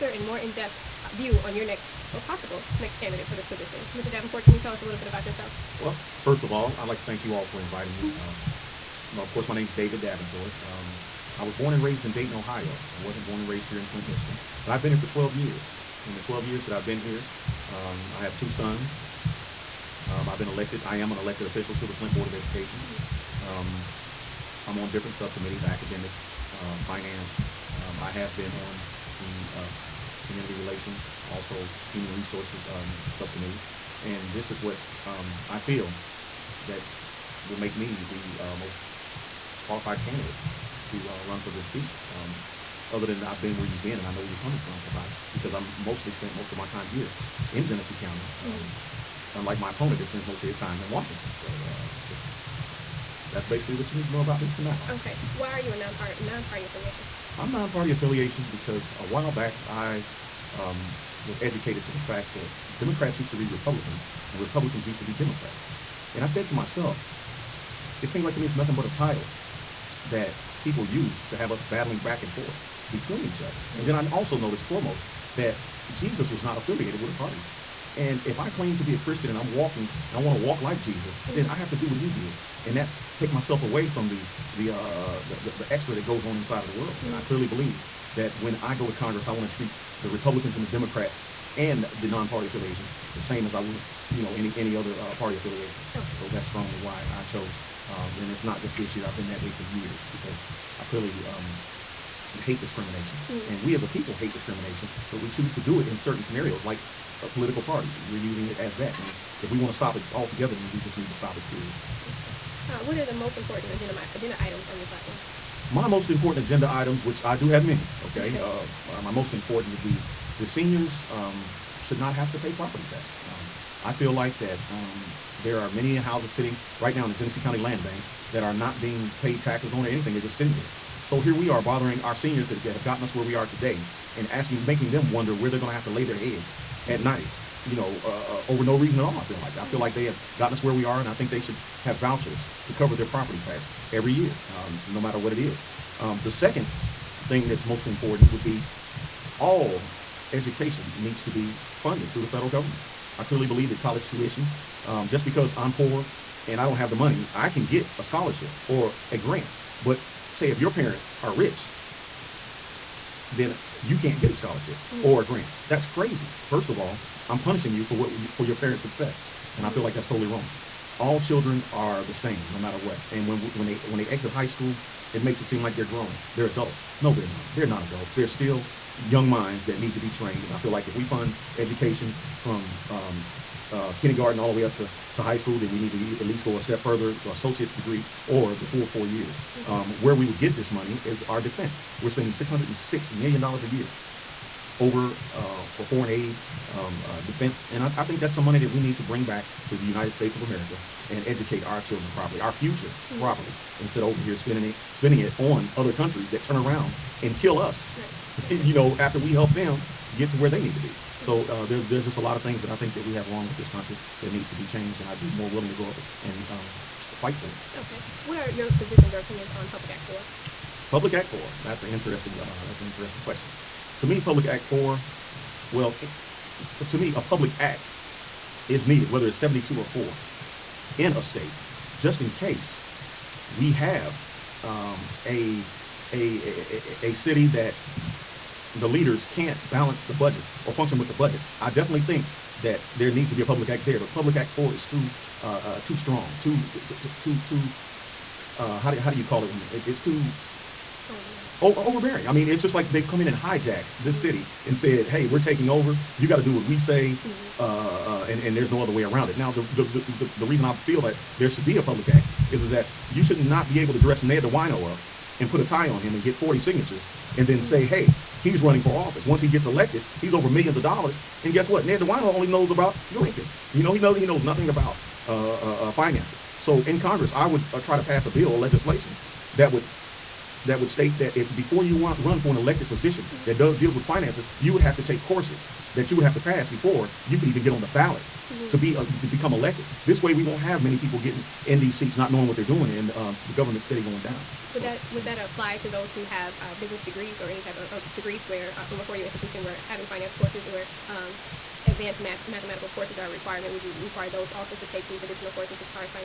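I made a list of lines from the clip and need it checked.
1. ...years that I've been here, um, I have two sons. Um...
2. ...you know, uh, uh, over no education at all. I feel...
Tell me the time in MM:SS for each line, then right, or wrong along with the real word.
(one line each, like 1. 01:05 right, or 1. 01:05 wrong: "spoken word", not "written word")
1. 00:16 right
2. 02:17 wrong: "reason", not "education".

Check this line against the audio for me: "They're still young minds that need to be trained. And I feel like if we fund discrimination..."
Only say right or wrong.
wrong.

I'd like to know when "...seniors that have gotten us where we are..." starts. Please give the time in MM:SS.
02:12.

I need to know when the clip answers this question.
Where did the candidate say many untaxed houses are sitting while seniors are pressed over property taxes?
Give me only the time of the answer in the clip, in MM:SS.
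02:07.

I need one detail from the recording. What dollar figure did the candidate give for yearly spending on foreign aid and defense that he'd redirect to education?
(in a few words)
$606 million.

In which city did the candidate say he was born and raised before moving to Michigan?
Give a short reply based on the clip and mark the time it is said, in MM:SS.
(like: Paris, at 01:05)
Dayton, Ohio, at 00:12.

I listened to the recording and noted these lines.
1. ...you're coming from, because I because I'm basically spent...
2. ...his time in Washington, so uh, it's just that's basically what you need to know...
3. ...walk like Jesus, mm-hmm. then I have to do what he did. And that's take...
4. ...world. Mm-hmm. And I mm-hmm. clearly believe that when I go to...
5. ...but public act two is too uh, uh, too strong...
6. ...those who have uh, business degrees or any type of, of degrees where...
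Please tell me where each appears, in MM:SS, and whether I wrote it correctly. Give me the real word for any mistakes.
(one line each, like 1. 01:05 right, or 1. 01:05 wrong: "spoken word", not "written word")
1. 00:44 wrong: "mostly", not "basically"
2. 00:50 right
3. 01:20 right
4. 01:26 right
5. 04:03 wrong: "four", not "two"
6. 04:55 right.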